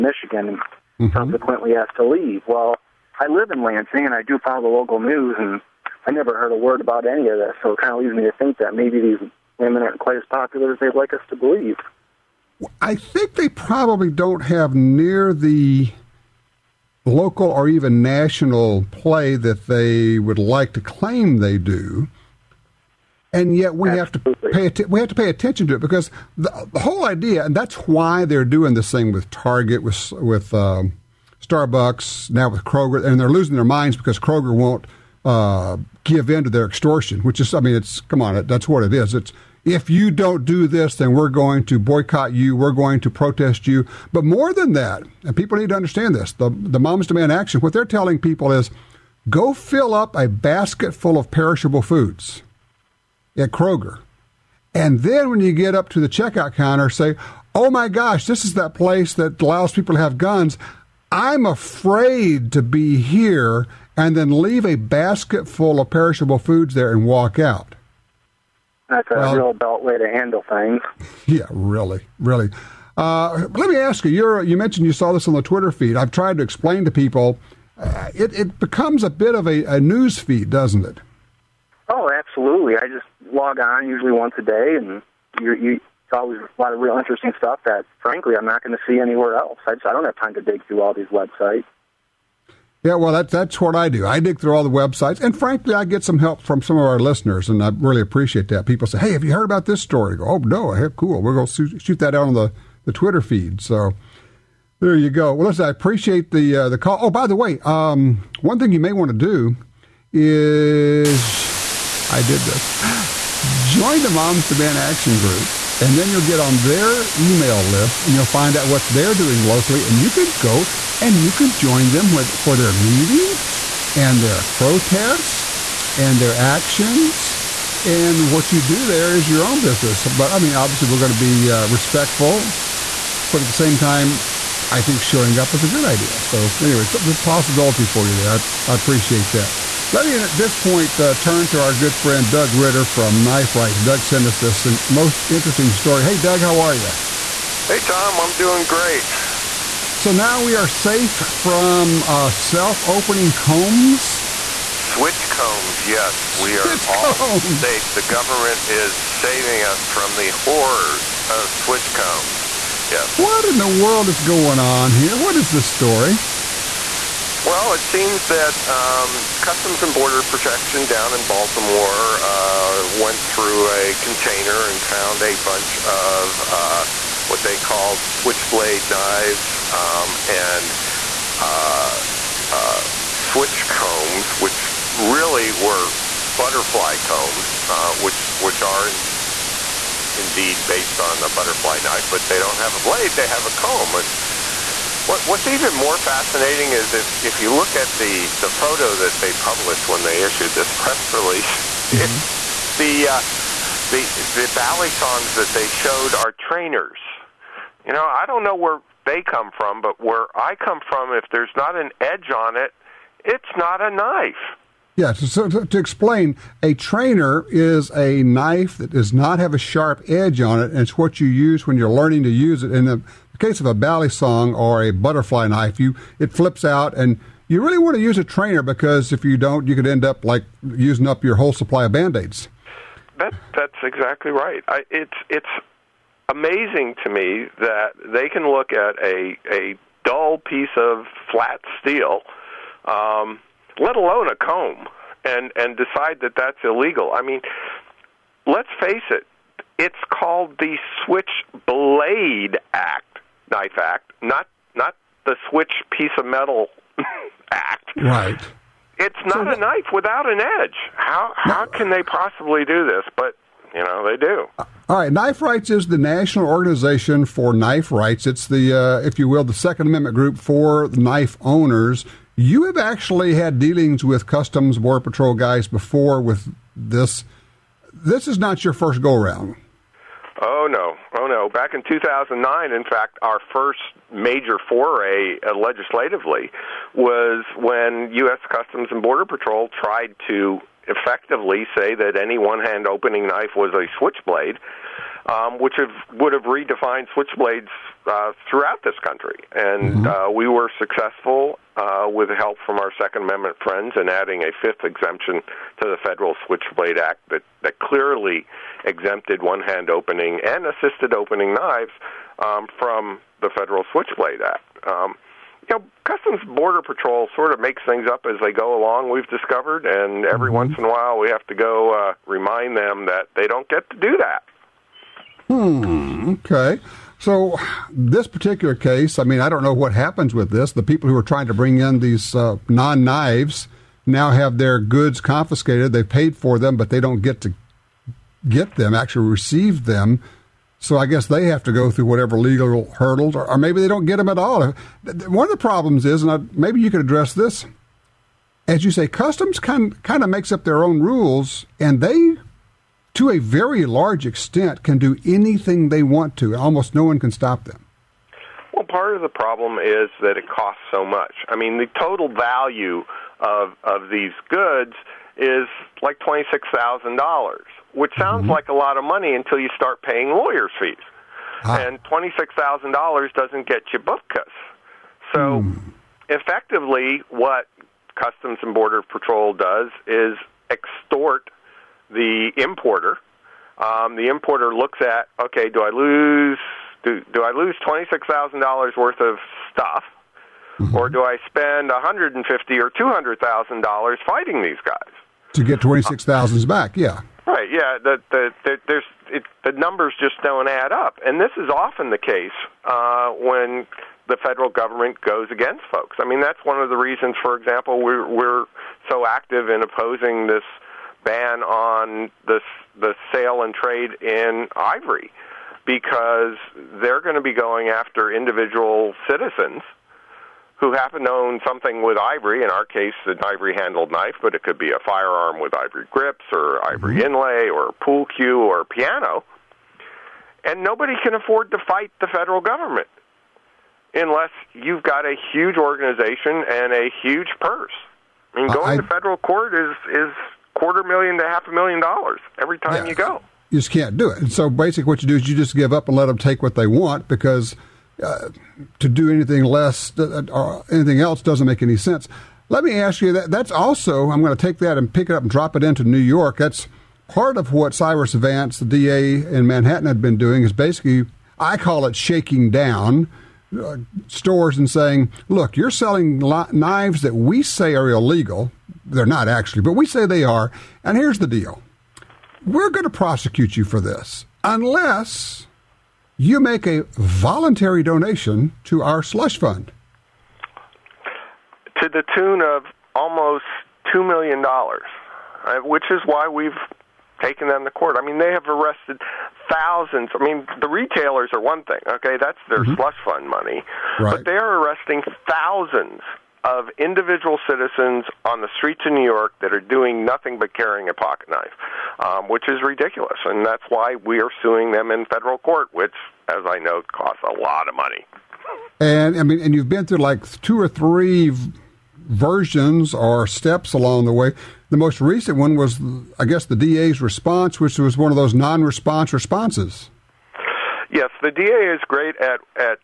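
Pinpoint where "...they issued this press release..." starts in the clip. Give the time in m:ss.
3:20.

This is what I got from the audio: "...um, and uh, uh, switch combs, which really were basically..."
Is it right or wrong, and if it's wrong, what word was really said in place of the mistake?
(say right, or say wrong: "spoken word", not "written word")
wrong: "butterfly", not "basically".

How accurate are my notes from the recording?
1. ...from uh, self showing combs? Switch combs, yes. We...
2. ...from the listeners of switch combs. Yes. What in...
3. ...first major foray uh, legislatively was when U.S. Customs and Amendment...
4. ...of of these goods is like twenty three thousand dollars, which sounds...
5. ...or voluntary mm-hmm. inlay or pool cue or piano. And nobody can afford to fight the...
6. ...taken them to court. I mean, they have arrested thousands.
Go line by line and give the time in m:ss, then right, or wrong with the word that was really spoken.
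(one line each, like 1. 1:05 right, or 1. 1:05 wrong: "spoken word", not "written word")
1. 2:31 wrong: "opening", not "showing"
2. 2:39 wrong: "horrors", not "listeners"
3. 4:43 wrong: "Border", not "Amendment"
4. 6:03 wrong: "six", not "three"
5. 7:06 wrong: "ivory", not "voluntary"
6. 8:07 right.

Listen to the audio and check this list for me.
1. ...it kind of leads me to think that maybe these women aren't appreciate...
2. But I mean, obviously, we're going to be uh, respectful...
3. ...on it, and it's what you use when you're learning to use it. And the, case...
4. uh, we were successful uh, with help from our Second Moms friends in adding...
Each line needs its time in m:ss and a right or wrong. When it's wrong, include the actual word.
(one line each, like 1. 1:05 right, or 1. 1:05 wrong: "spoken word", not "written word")
1. 0:07 wrong: "quite", not "appreciate"
2. 2:10 right
3. 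3:40 right
4. 5:00 wrong: "Amendment", not "Moms".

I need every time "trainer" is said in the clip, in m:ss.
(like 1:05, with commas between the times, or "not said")
3:26, 3:36, 3:48.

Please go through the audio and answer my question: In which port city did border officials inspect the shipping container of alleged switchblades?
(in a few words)
Baltimore.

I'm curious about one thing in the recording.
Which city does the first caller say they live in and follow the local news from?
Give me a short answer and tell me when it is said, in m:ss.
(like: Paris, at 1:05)
Lansing, at 0:03.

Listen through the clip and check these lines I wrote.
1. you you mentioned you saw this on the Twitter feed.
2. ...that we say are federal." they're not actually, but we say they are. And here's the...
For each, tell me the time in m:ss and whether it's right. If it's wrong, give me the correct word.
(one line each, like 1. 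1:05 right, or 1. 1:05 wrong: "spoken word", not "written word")
1. 1:14 right
2. 7:47 wrong: "illegal", not "federal".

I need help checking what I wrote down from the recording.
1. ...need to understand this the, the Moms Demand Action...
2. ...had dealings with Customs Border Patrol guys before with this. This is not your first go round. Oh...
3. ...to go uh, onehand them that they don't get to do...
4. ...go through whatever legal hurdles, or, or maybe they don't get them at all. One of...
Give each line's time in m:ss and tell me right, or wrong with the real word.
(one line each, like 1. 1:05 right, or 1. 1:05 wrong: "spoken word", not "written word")
1. 0:45 right
2. 4:33 right
3. 5:21 wrong: "remind", not "onehand"
4. 5:41 right.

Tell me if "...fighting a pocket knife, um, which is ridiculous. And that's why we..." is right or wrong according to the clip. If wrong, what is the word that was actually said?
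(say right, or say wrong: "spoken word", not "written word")
wrong: "carrying", not "fighting".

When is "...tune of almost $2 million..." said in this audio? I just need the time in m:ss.
8:02.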